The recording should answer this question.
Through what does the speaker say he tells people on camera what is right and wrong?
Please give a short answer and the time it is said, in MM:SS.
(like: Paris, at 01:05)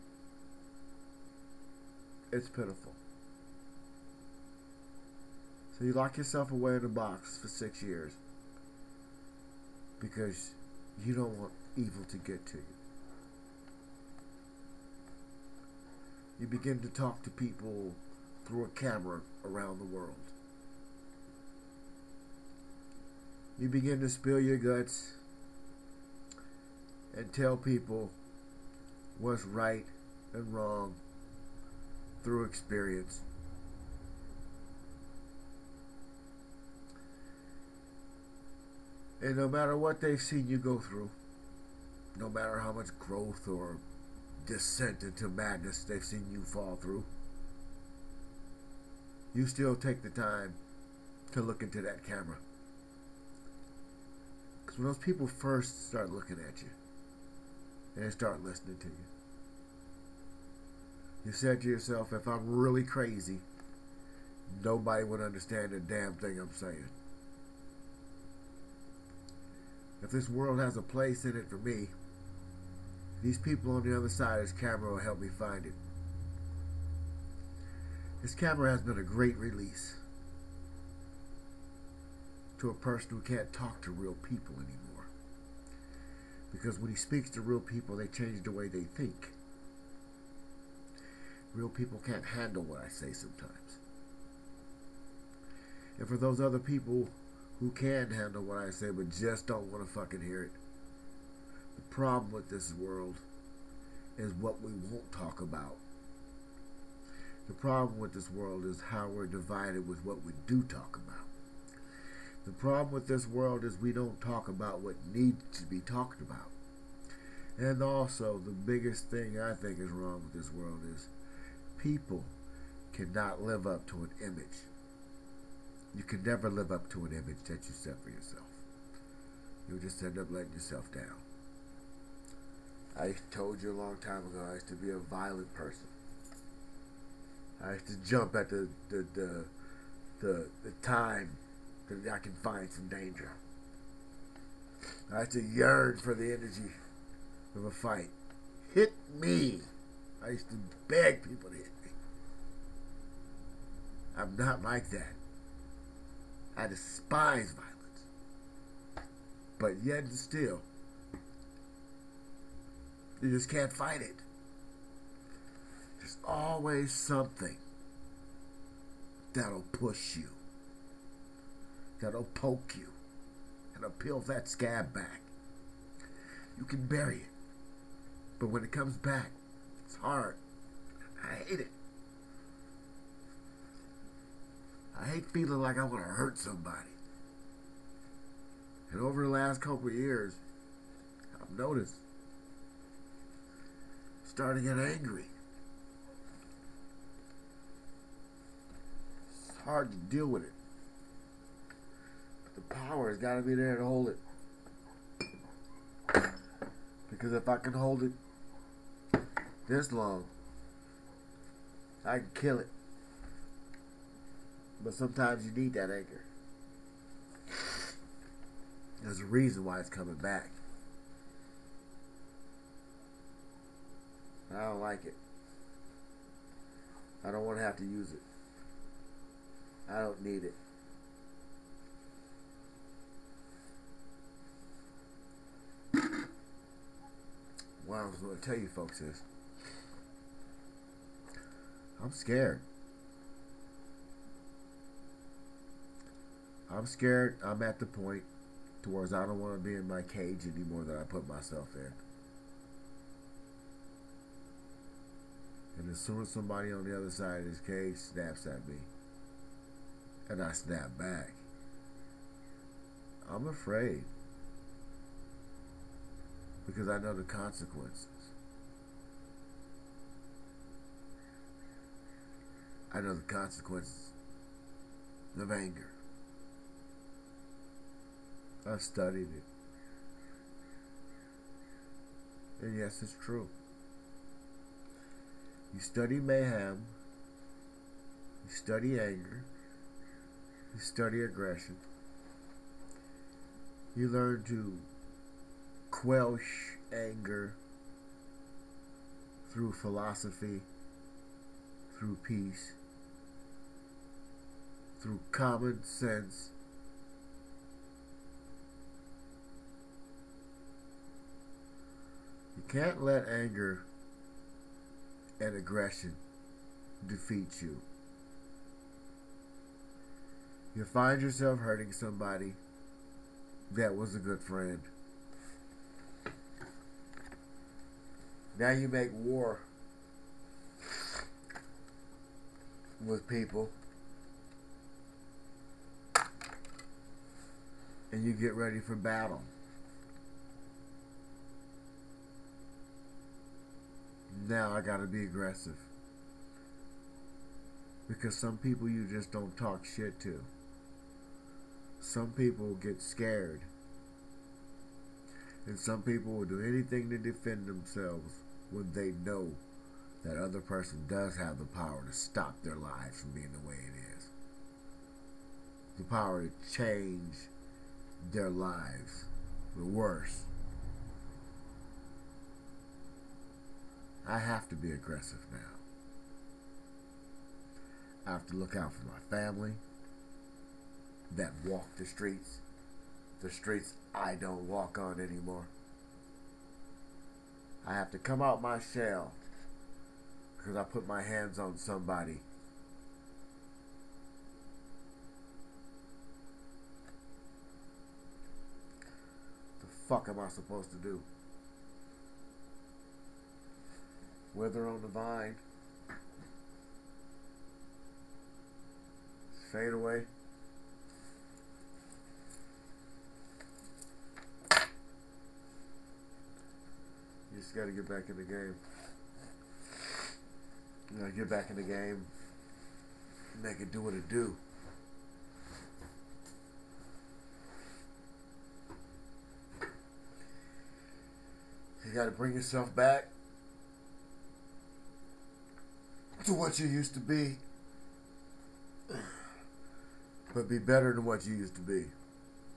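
experience, at 00:32.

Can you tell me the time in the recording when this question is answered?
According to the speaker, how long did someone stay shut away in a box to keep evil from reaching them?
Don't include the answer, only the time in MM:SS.
00:07.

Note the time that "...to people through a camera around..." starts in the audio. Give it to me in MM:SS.
00:17.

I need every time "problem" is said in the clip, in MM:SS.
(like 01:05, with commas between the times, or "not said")
01:41, 01:47, 01:52.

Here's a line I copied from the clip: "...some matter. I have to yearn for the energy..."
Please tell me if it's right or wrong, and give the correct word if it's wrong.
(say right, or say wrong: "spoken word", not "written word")
wrong: "danger", not "matter".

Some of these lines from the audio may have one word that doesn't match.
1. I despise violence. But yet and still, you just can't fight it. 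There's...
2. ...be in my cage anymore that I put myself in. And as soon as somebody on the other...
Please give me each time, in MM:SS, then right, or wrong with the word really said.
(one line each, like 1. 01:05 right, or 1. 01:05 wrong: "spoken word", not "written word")
1. 02:36 right
2. 04:09 right.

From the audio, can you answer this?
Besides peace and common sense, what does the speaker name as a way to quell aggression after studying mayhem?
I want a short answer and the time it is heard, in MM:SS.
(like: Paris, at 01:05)
philosophy, at 04:59.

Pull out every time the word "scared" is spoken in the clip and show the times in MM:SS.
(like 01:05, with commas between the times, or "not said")
04:02, 04:06, 05:53.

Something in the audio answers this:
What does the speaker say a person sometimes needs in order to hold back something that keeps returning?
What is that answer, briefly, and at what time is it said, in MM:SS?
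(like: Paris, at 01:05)
anchor, at 03:35.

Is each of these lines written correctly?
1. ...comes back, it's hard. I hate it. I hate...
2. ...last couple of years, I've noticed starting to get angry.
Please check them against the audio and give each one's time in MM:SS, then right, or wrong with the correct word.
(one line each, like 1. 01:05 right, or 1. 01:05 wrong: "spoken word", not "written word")
1. 02:58 right
2. 03:09 right.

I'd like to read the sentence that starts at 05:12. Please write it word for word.
You can't let anger and aggression defeat you.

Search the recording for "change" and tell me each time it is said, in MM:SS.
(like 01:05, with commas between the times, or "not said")
01:28, 06:06.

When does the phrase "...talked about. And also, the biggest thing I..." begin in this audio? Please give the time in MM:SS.
01:55.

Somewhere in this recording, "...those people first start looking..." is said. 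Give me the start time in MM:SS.
00:54.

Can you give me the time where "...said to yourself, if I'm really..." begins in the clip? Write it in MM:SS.
01:01.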